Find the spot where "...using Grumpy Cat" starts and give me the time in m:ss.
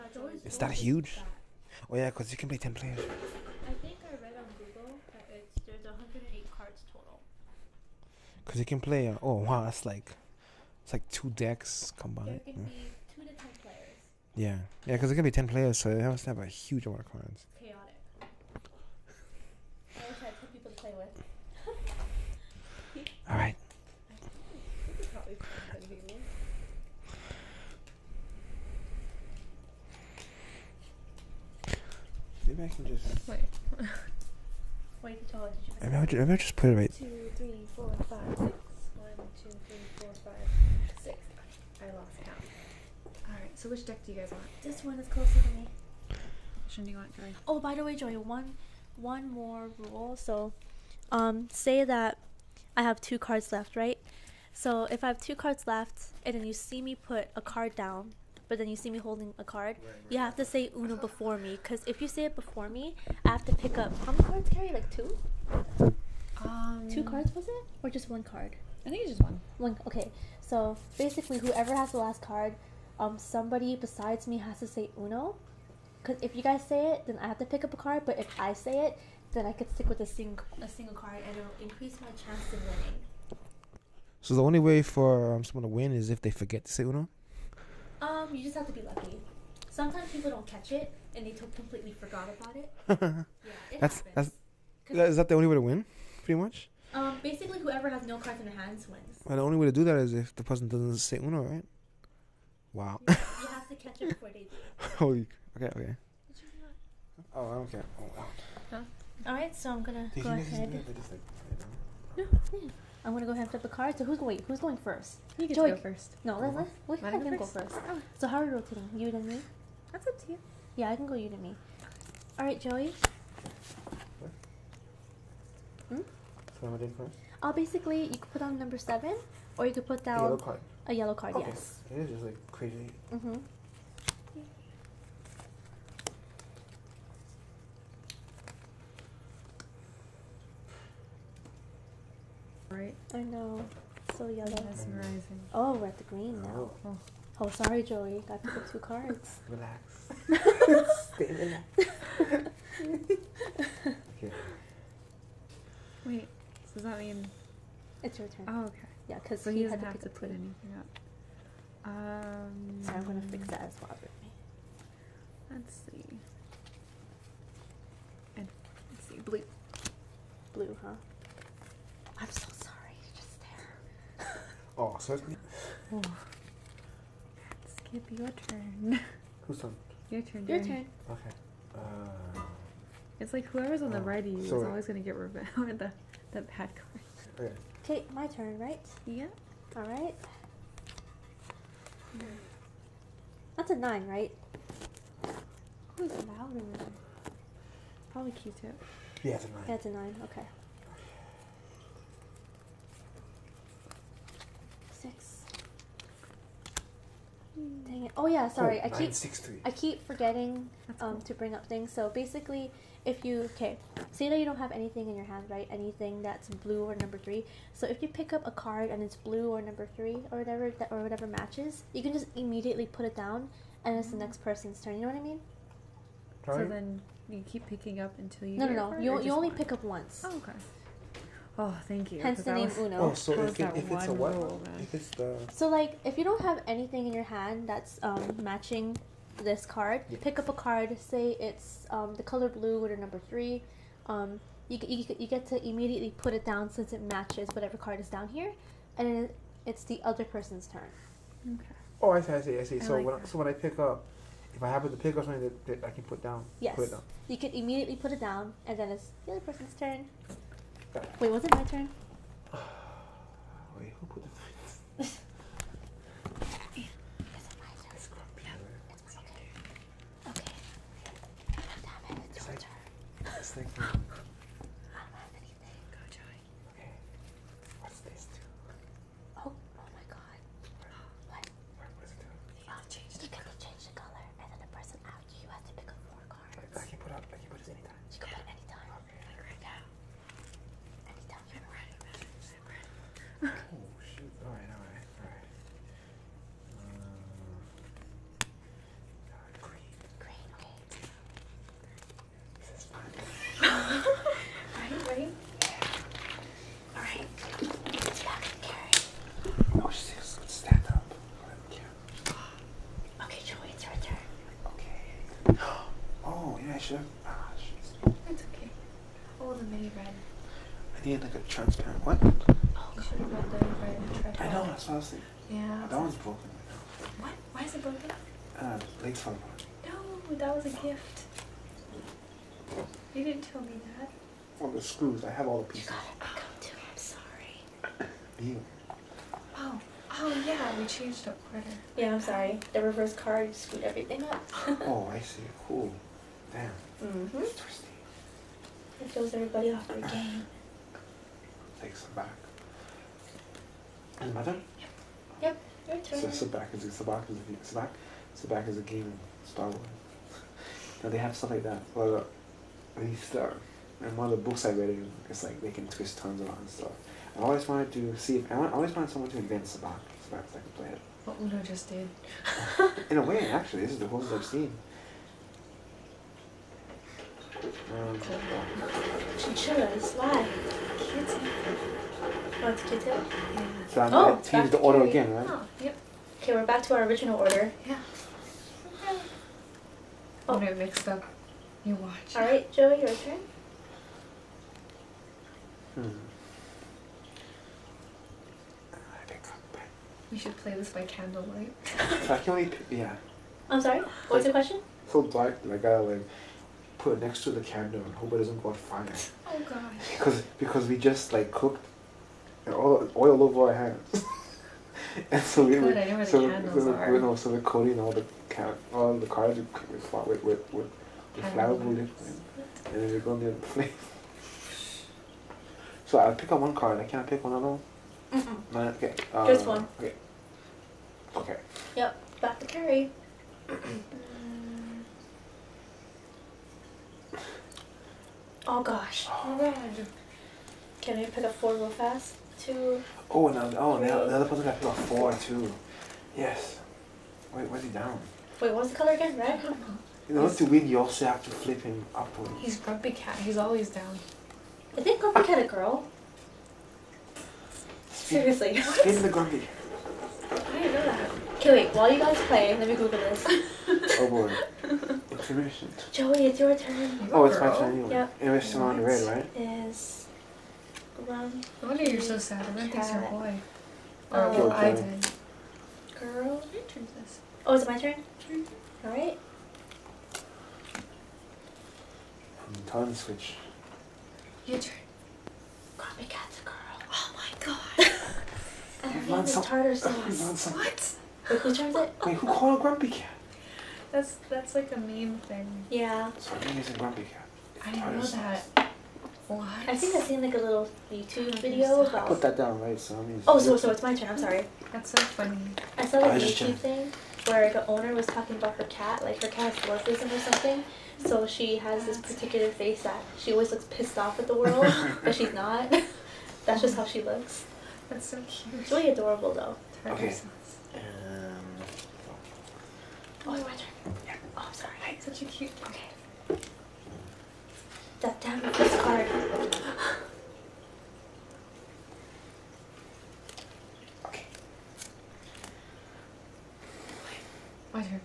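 8:16.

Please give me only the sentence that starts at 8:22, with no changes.
Put that down right, so Oh, so so it's my turn.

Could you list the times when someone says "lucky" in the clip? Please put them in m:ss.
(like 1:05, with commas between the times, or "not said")
1:28.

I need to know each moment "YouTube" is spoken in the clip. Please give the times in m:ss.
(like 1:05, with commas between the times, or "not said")
8:21, 8:26.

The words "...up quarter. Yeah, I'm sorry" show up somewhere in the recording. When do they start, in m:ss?
5:41.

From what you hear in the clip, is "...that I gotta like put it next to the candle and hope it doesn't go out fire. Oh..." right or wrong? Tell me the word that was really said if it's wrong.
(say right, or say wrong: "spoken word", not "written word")
right.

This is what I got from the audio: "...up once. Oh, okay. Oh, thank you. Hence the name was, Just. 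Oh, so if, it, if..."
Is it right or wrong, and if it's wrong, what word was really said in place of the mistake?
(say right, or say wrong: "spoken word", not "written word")
wrong: "Uno", not "Just".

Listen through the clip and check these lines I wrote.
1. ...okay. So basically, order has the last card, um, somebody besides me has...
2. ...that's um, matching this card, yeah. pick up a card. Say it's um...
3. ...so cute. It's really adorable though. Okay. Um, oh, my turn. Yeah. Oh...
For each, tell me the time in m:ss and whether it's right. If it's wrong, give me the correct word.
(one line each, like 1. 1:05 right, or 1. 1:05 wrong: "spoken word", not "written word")
1. 1:09 wrong: "whoever", not "order"
2. 3:57 right
3. 8:38 right.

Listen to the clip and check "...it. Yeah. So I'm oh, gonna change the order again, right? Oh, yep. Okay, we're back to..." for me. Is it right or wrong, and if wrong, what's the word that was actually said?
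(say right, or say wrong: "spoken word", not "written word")
right.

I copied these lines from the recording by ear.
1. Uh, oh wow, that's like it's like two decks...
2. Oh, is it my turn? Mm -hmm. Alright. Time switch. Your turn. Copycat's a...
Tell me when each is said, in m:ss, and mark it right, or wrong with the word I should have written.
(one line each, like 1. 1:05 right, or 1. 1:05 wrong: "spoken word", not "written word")
1. 0:09 right
2. 7:57 right.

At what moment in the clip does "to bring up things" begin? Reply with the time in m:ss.
3:31.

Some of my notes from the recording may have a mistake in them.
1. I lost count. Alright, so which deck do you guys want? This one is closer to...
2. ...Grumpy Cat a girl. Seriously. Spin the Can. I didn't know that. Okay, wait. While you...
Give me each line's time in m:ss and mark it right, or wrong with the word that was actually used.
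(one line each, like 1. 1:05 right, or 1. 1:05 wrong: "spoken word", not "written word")
1. 0:41 right
2. 7:35 wrong: "Grumpy", not "Can".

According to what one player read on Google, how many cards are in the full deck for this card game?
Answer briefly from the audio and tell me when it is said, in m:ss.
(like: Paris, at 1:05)
108, at 0:05.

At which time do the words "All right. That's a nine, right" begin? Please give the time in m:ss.
3:09.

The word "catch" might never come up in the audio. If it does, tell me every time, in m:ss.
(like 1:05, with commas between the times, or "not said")
1:30, 1:43.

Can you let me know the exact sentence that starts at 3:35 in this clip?
Anything that's blue or number three.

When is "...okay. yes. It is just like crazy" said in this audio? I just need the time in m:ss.
2:11.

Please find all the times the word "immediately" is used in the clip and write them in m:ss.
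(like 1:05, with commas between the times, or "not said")
3:42, 4:05, 4:17.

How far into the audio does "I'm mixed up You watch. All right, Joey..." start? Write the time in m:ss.
6:30.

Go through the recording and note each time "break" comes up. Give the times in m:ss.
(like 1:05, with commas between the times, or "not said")
not said.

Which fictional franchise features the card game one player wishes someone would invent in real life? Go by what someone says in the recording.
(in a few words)
Star Wars.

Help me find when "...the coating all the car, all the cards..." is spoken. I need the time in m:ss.
6:57.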